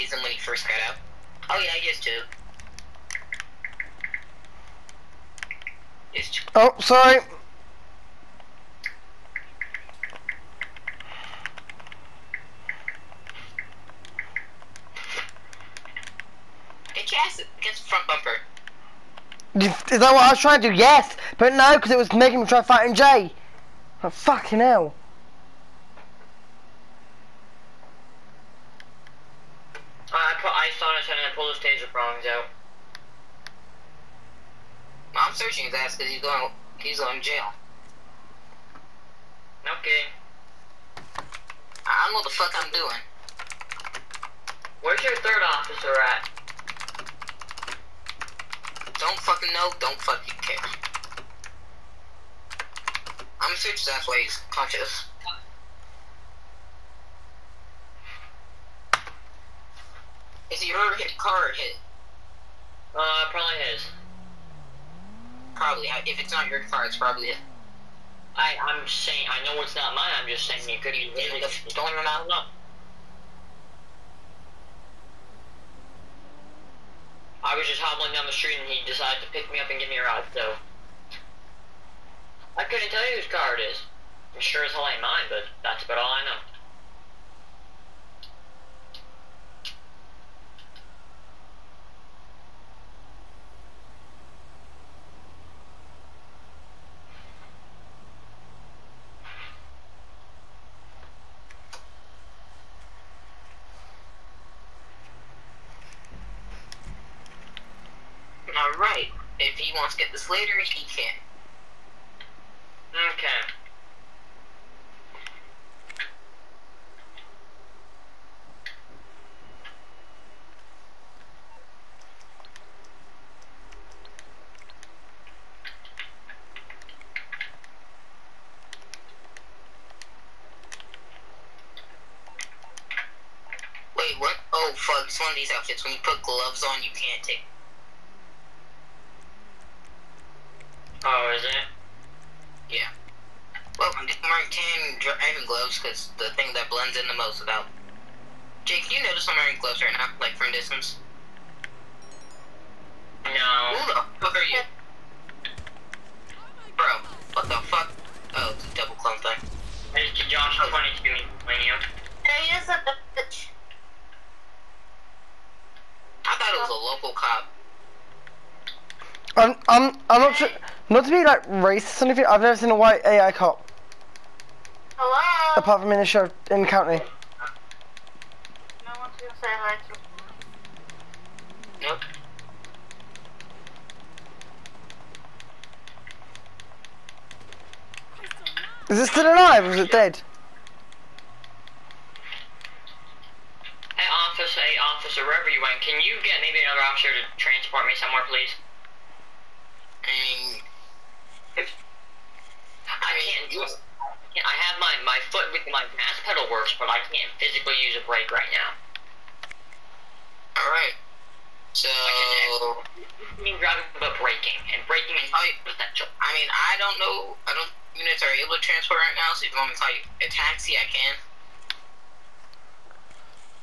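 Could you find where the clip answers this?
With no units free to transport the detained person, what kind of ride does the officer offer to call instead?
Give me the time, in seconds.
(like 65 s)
220 s.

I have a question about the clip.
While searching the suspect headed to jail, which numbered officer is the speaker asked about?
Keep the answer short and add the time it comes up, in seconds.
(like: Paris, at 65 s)
third officer, at 45 s.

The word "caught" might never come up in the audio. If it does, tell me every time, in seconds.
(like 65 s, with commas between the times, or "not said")
not said.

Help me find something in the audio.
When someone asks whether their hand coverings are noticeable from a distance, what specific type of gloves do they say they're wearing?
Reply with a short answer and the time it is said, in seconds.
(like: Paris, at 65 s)
driving gloves, at 145 s.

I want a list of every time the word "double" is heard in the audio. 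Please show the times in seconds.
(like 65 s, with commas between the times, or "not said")
158 s.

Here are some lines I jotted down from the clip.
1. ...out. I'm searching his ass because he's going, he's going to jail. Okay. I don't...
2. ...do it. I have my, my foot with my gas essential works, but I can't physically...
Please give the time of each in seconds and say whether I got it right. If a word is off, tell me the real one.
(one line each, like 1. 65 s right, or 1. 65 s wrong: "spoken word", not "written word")
1. 32 s right
2. 203 s wrong: "pedal", not "essential".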